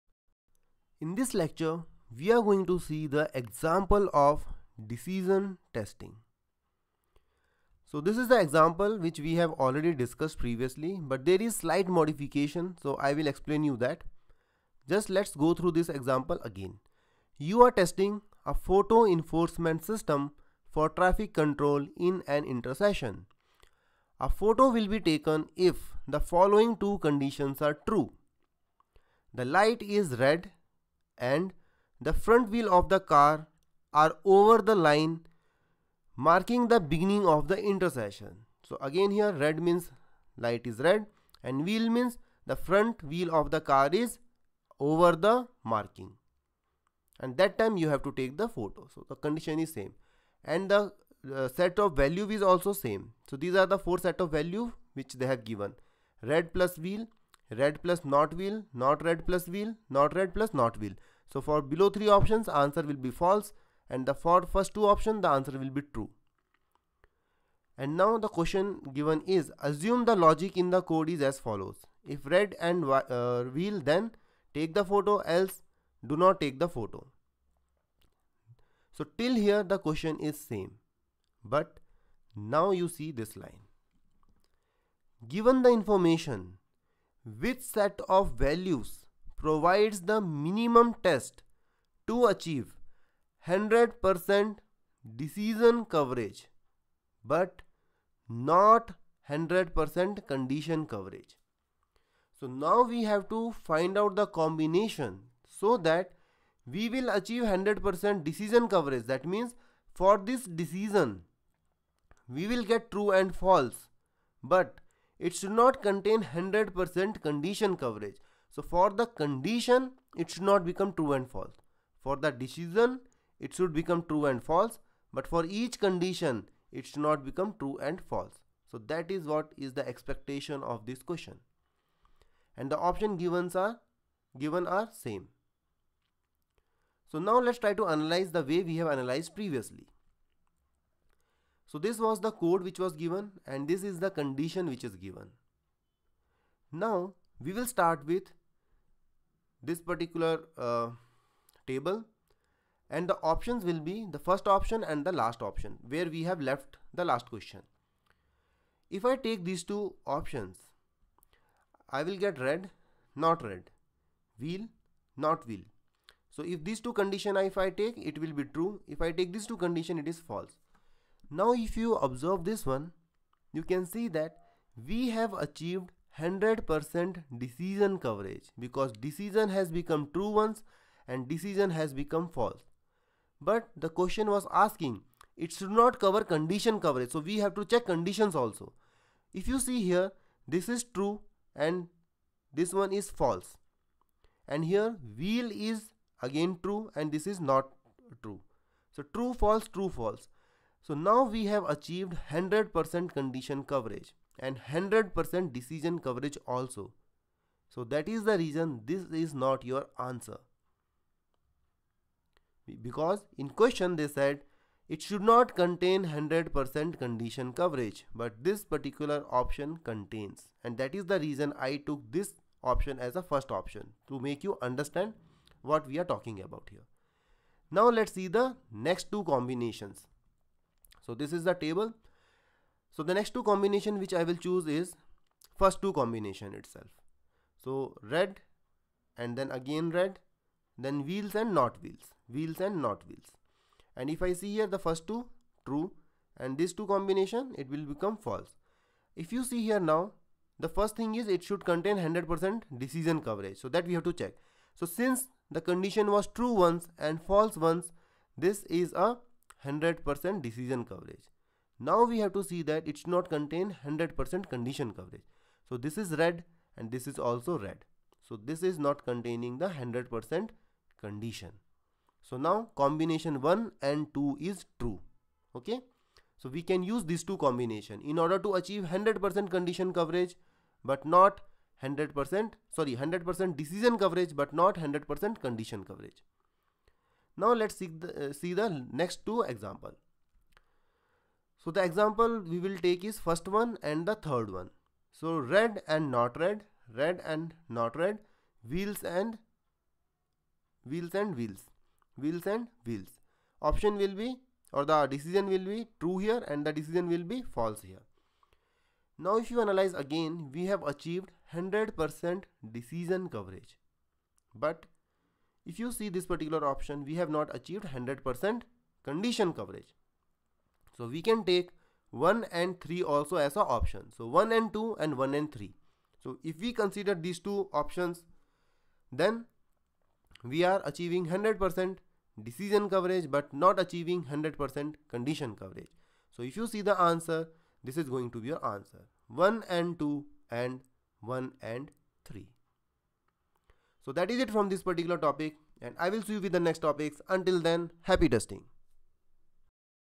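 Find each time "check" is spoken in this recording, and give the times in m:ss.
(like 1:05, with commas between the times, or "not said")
3:07, 4:14.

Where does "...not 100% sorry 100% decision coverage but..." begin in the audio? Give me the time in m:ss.
4:41.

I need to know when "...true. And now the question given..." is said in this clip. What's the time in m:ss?
1:05.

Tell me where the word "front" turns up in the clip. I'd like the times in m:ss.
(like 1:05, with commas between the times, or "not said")
0:32, 0:42.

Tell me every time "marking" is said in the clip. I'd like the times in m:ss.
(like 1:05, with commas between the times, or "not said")
0:36, 0:45.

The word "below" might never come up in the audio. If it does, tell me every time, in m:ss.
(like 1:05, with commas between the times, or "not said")
1:01.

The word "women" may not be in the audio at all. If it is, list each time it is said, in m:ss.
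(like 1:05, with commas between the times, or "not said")
not said.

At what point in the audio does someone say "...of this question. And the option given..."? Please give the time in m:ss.
2:10.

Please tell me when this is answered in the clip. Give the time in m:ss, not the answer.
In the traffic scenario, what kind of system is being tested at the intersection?
0:18.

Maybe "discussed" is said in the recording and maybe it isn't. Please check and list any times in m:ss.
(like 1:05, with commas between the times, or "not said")
0:09.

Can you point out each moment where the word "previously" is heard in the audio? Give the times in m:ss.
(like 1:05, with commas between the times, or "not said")
0:10, 2:19.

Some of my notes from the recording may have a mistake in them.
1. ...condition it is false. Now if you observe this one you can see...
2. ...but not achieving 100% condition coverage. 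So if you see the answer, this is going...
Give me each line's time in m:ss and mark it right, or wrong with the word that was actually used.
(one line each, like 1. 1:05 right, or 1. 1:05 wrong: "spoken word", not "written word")
1. 2:49 right
2. 5:33 right.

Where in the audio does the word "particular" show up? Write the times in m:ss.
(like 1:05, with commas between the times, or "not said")
2:29, 3:38, 5:16, 5:44.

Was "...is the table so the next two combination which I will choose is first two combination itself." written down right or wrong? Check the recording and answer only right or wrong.
right.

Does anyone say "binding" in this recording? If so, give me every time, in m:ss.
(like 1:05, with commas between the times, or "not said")
not said.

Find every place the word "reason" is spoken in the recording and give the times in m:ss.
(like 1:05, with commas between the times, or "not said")
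3:28, 3:41.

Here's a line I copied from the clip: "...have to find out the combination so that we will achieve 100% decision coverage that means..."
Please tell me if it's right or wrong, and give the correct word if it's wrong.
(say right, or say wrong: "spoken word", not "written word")
right.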